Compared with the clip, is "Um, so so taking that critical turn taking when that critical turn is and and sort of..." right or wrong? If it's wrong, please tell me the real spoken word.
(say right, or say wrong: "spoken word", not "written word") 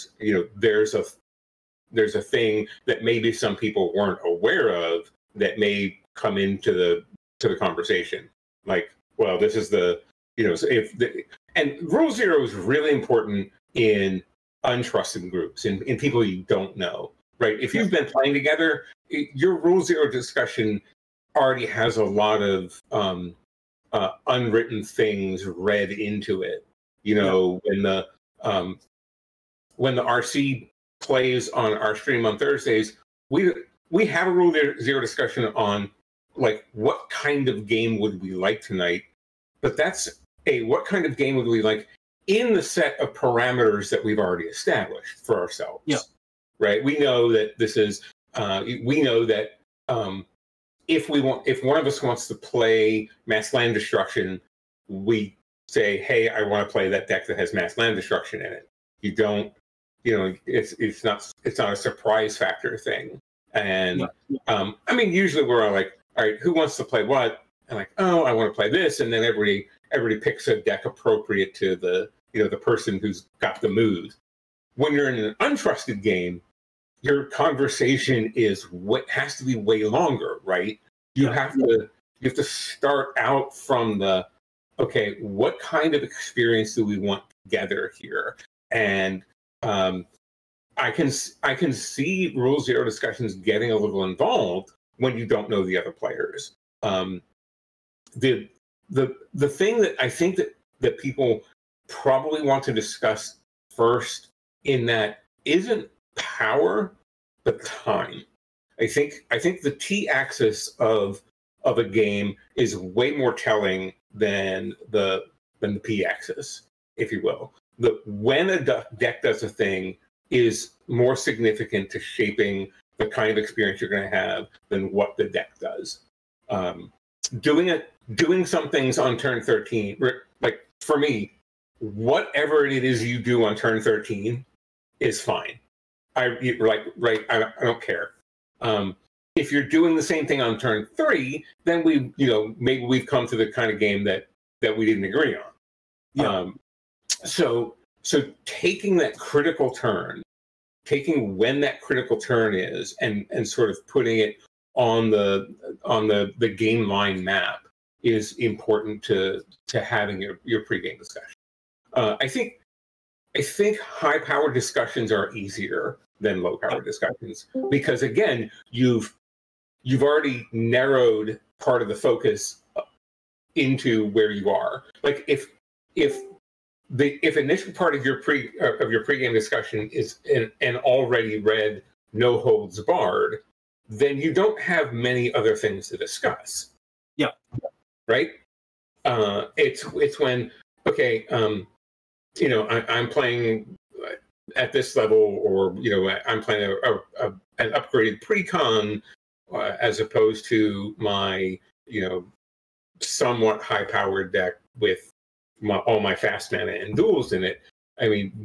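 right.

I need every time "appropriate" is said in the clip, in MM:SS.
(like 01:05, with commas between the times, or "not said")
01:10.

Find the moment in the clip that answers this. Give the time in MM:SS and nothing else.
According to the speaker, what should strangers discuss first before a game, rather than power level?
01:47.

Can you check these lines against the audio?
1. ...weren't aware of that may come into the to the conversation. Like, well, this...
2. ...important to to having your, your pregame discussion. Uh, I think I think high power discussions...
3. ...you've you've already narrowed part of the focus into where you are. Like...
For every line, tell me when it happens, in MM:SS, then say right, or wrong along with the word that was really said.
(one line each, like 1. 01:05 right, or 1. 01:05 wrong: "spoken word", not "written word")
1. 00:03 right
2. 02:38 right
3. 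02:48 right.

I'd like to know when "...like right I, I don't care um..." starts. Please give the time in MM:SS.
02:16.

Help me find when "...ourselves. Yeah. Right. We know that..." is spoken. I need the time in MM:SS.
00:45.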